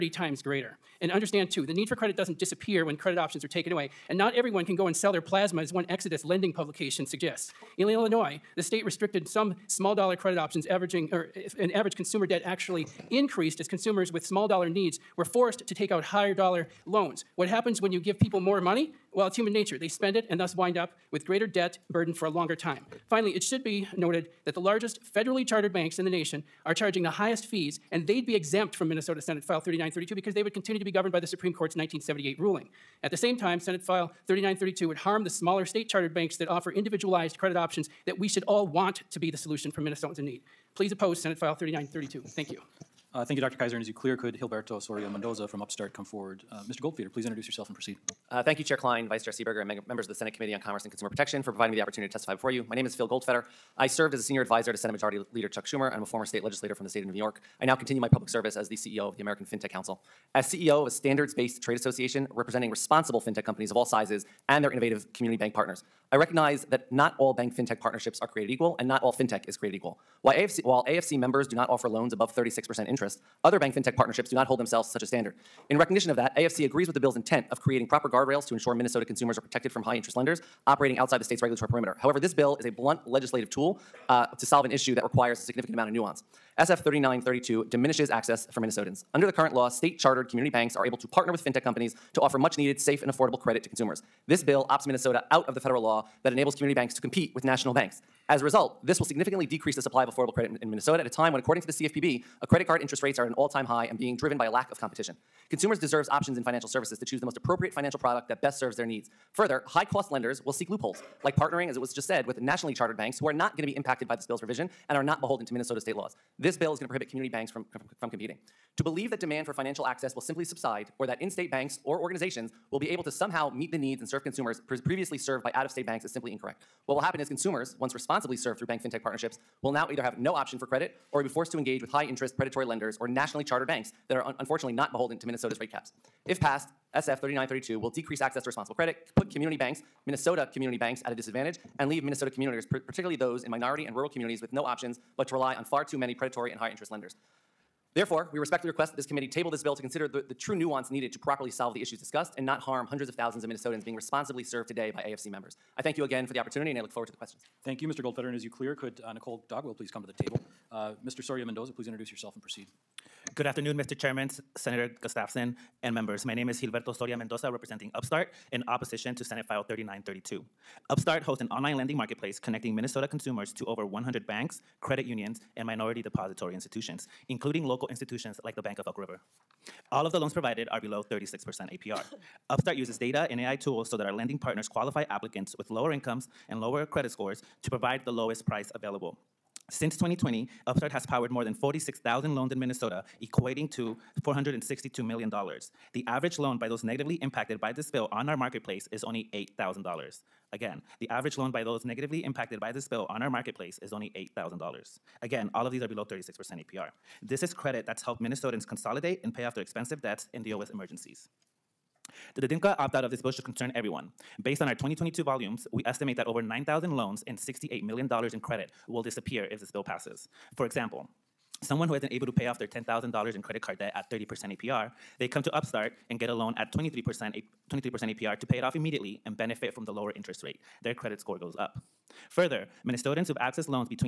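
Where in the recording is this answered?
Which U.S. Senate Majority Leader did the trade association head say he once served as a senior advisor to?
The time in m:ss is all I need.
0:55.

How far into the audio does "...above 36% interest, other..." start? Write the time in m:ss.
1:12.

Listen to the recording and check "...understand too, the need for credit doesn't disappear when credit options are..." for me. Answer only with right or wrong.
right.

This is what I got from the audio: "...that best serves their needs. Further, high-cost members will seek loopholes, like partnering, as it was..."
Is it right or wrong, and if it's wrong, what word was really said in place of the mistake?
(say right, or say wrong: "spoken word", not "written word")
wrong: "lenders", not "members".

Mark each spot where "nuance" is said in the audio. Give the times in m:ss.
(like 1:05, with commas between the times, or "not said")
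1:25, 2:30.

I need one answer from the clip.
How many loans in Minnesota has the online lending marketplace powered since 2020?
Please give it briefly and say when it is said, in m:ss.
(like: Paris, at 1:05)
46,000, at 3:11.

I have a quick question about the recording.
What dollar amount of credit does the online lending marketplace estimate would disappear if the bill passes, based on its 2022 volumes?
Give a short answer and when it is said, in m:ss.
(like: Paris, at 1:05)
$68 million, at 3:37.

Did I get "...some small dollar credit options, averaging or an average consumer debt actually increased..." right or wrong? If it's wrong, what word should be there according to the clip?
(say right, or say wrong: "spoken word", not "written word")
right.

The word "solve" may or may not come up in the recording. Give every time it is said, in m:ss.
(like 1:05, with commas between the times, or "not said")
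1:24, 2:31.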